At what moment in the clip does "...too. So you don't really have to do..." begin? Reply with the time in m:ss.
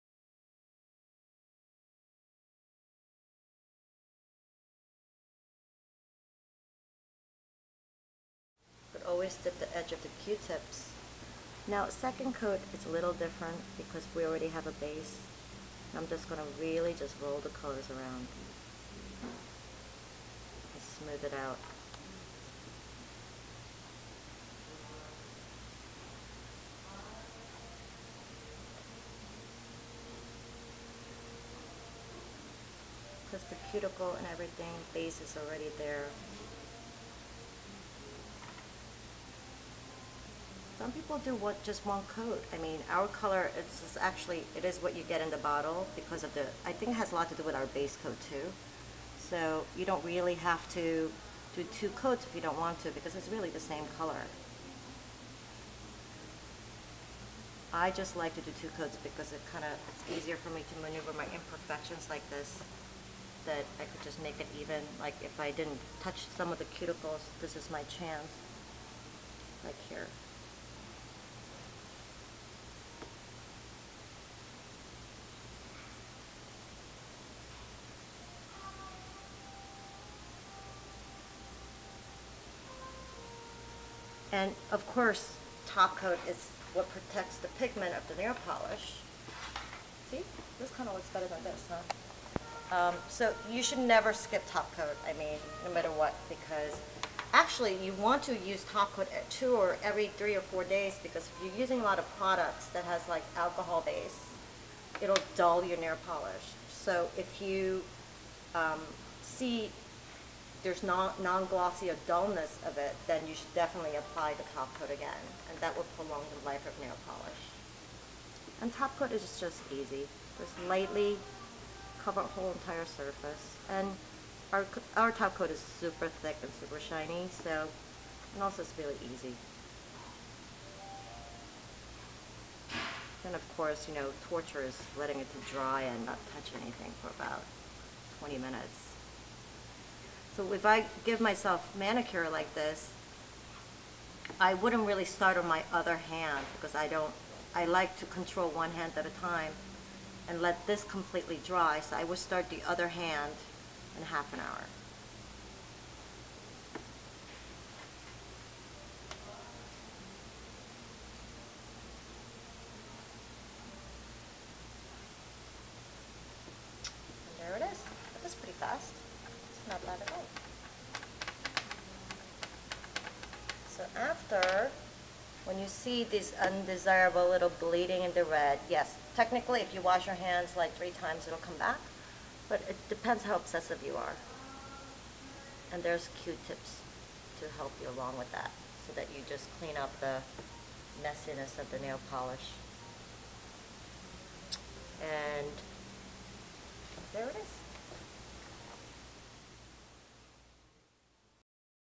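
0:48.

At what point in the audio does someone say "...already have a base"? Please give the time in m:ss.
0:14.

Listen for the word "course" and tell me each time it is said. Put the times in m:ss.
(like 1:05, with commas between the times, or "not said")
1:24, 2:13.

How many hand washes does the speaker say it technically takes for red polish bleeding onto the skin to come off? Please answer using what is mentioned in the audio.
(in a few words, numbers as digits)
3.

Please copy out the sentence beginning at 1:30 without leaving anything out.
See, this kind of looks better than this, huh?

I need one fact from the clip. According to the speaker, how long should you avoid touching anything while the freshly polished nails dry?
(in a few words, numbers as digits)
20 minutes.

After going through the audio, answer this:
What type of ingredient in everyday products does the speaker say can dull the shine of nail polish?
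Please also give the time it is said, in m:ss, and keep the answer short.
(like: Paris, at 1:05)
Alcohol, at 1:43.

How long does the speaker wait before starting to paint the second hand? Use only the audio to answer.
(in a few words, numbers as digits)
Half an hour.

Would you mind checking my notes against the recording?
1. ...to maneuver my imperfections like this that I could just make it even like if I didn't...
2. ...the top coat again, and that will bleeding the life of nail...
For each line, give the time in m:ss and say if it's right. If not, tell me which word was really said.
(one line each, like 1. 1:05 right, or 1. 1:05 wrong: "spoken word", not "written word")
1. 1:00 right
2. 1:54 wrong: "prolong", not "bleeding".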